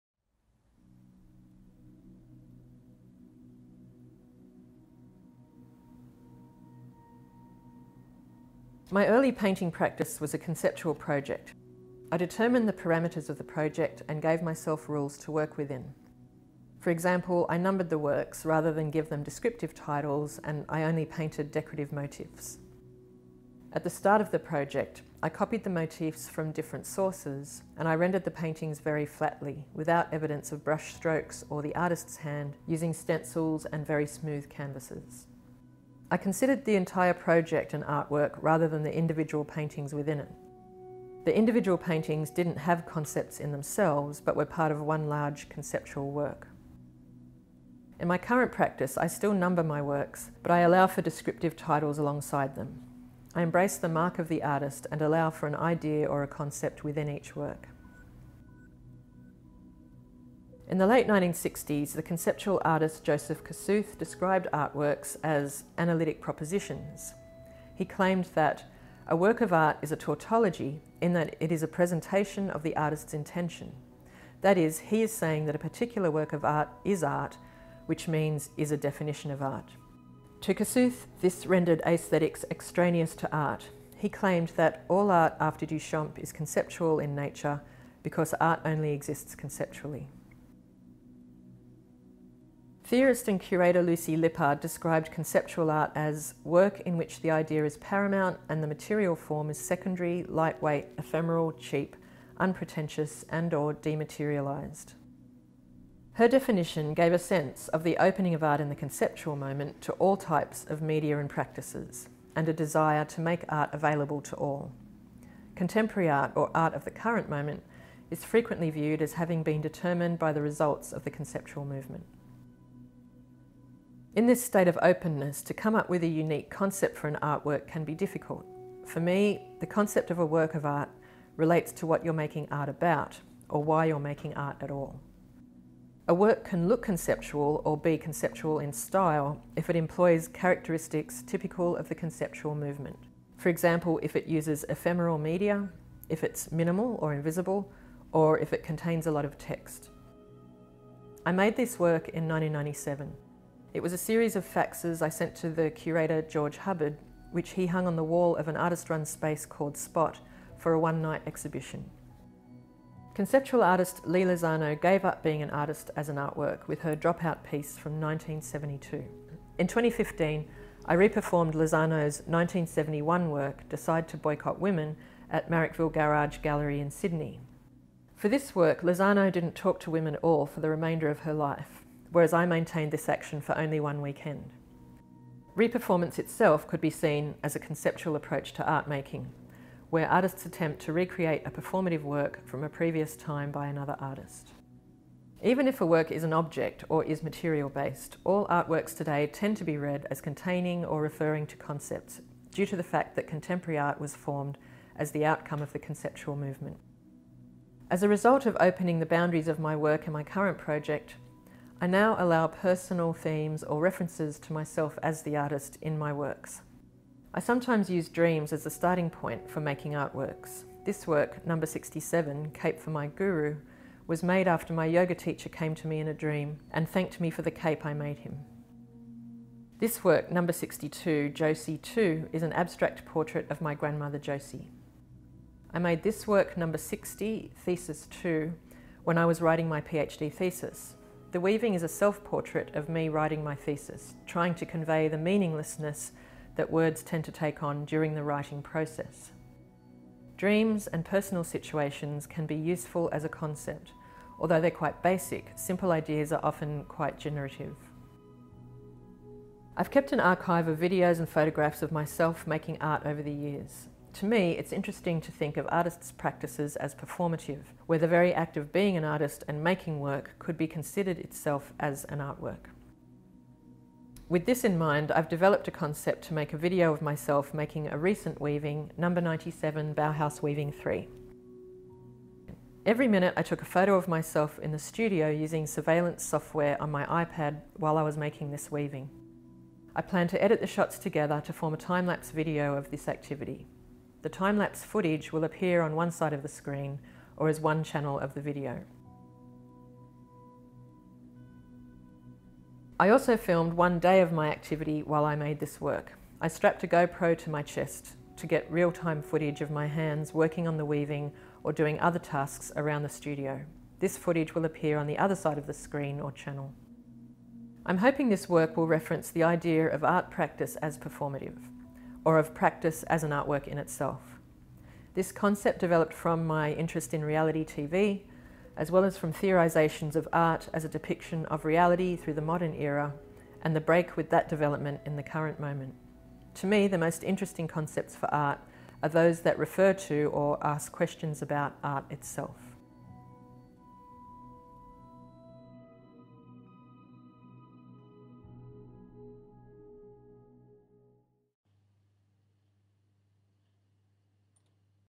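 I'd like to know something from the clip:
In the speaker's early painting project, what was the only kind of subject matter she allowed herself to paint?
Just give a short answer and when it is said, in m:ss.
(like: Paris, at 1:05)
Decorative motifs, at 0:21.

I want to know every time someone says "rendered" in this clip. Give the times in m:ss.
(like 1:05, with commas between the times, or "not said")
0:27, 1:21.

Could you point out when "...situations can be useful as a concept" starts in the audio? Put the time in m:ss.
4:11.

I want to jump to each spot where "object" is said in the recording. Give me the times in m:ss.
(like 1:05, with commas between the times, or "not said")
3:16.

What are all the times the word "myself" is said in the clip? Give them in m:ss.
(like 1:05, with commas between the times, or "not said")
0:14, 3:34, 4:21, 4:37, 4:44.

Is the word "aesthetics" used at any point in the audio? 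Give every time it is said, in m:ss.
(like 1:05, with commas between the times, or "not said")
1:21.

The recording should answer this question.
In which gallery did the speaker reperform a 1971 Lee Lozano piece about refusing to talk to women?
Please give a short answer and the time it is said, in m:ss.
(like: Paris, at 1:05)
Marrickville Garage Gallery, at 2:55.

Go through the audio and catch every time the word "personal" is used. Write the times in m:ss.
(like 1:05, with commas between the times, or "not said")
3:32, 4:11.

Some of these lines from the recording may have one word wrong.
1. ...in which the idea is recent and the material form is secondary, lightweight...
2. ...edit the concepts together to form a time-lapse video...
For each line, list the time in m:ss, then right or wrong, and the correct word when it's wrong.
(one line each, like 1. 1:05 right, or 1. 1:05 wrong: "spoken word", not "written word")
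1. 1:36 wrong: "paramount", not "recent"
2. 4:50 wrong: "shots", not "concepts".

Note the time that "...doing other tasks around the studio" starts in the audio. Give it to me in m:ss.
5:11.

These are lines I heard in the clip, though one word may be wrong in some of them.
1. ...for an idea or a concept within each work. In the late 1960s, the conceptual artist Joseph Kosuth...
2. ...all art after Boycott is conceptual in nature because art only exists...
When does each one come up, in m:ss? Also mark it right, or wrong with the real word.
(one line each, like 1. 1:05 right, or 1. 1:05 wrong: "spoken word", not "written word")
1. 0:55 right
2. 1:24 wrong: "Duchamp", not "Boycott".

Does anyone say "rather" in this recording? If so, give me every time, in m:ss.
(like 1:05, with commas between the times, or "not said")
0:18, 0:38.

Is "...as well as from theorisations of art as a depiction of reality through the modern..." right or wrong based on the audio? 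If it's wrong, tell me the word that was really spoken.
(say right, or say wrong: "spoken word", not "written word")
right.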